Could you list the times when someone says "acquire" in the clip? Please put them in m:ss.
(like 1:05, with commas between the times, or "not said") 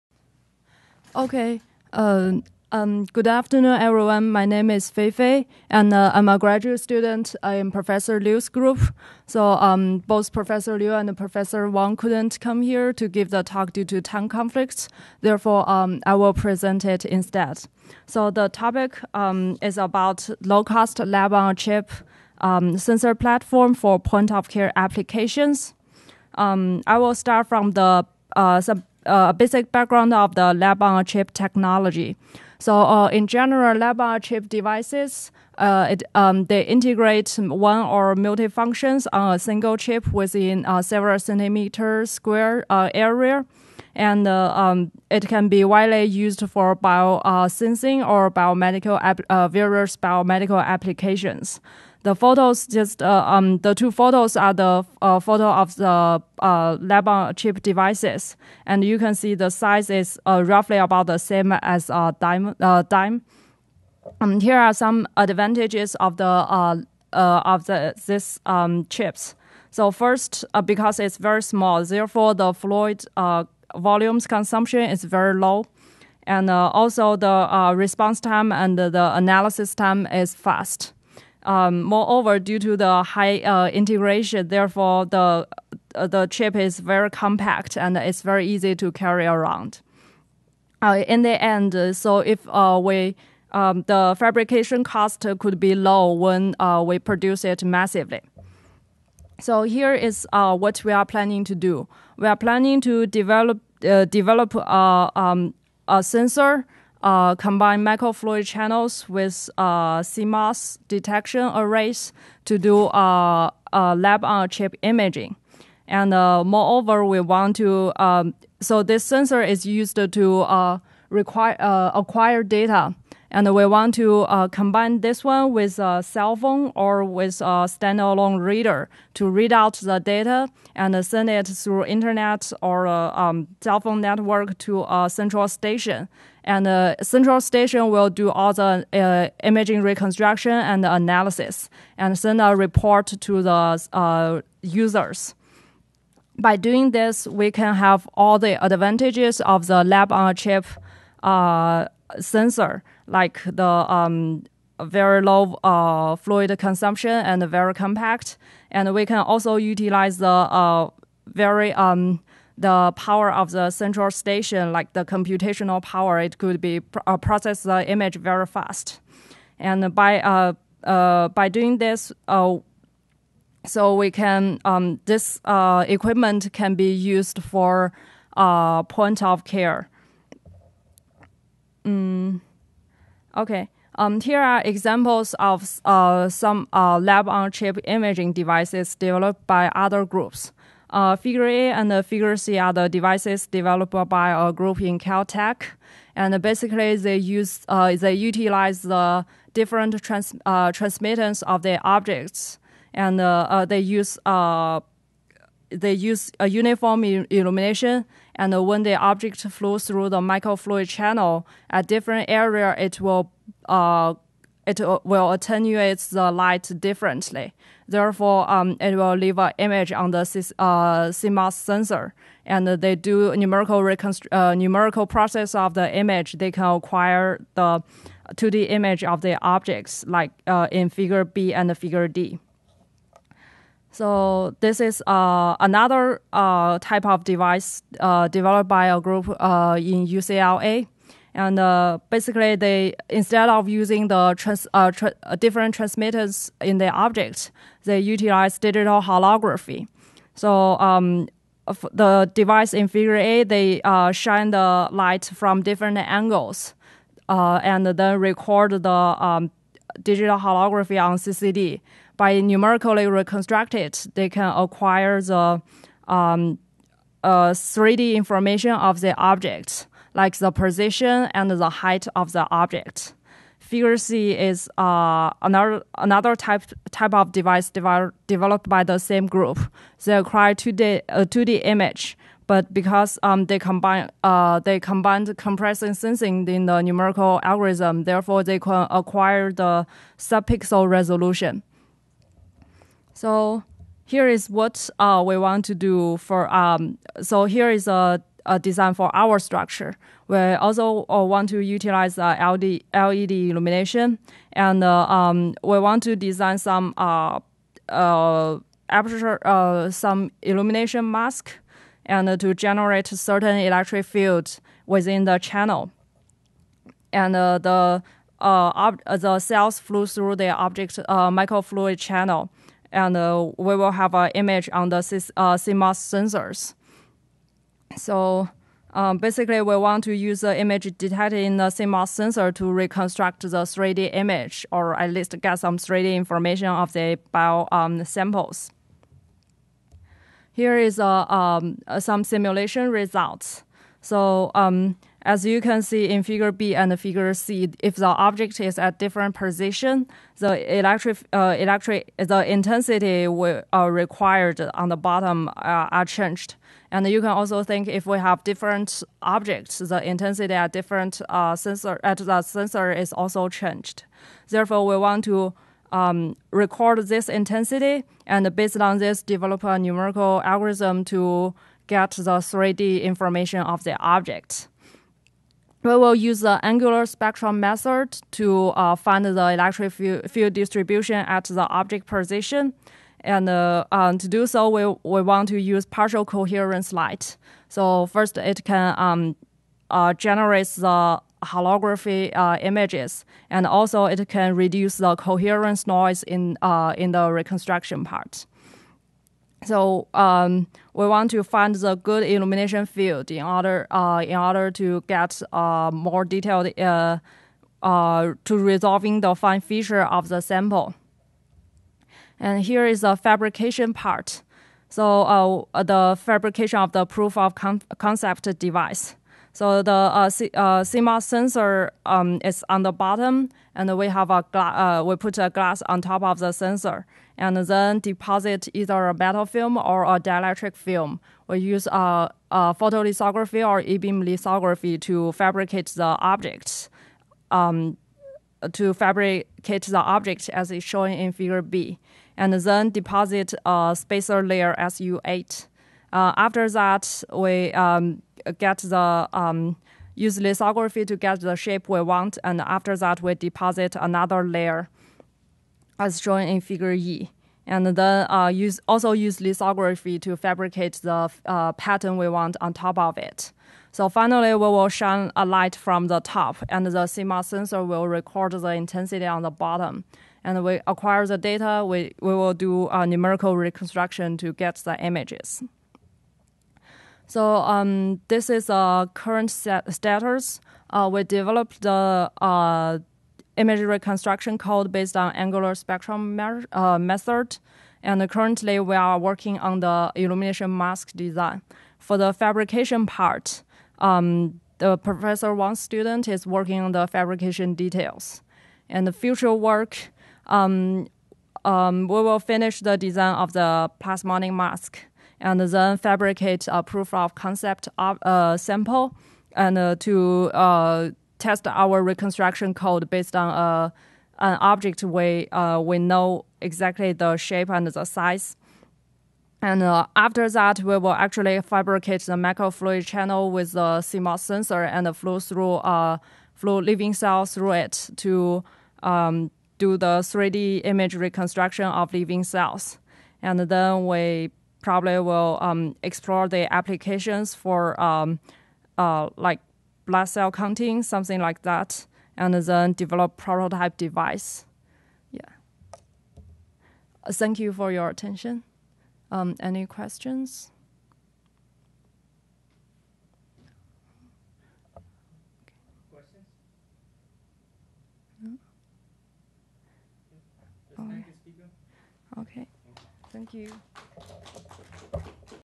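2:01, 3:46, 4:24, 4:40, 4:48, 7:50.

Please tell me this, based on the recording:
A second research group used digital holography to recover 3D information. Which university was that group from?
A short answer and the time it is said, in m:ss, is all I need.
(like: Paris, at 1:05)
UCLA, at 4:00.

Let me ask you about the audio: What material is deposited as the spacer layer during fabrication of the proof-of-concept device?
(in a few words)
SU8.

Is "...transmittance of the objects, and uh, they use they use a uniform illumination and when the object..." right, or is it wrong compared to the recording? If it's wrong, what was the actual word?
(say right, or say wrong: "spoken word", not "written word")
right.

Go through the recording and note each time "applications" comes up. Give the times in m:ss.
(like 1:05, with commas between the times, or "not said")
0:24, 0:50, 8:56.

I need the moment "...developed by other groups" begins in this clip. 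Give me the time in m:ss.
3:08.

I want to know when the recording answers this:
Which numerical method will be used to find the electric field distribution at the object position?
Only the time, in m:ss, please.
6:16.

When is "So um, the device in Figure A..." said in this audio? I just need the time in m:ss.
4:10.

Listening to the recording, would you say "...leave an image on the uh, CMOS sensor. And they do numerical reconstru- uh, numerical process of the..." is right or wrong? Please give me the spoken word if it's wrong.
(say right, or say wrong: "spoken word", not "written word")
right.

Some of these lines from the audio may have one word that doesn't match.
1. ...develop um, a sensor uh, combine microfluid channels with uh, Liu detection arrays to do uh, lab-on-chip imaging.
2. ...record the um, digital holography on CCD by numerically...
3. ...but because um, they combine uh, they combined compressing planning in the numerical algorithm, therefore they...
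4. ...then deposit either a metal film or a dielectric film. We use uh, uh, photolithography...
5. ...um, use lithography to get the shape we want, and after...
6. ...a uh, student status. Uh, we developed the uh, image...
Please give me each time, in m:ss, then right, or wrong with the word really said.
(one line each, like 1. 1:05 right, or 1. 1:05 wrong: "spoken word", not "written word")
1. 1:43 wrong: "CMOS", not "Liu"
2. 4:18 right
3. 4:42 wrong: "sensing", not "planning"
4. 7:07 right
5. 7:29 right
6. 7:58 wrong: "current", not "student".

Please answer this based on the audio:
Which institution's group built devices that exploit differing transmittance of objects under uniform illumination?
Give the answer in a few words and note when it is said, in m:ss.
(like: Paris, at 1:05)
Caltech, at 3:14.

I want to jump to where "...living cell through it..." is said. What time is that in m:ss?
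8:46.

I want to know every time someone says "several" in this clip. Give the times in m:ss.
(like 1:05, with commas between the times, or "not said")
0:40.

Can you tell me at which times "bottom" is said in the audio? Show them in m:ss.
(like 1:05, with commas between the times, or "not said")
5:54, 7:02, 7:49.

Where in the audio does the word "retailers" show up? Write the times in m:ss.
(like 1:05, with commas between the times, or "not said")
not said.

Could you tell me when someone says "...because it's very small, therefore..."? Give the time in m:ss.
1:10.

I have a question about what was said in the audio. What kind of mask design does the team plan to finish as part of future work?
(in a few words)
Plasmonic mask.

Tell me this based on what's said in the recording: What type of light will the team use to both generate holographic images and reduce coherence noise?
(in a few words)
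Partial coherence light.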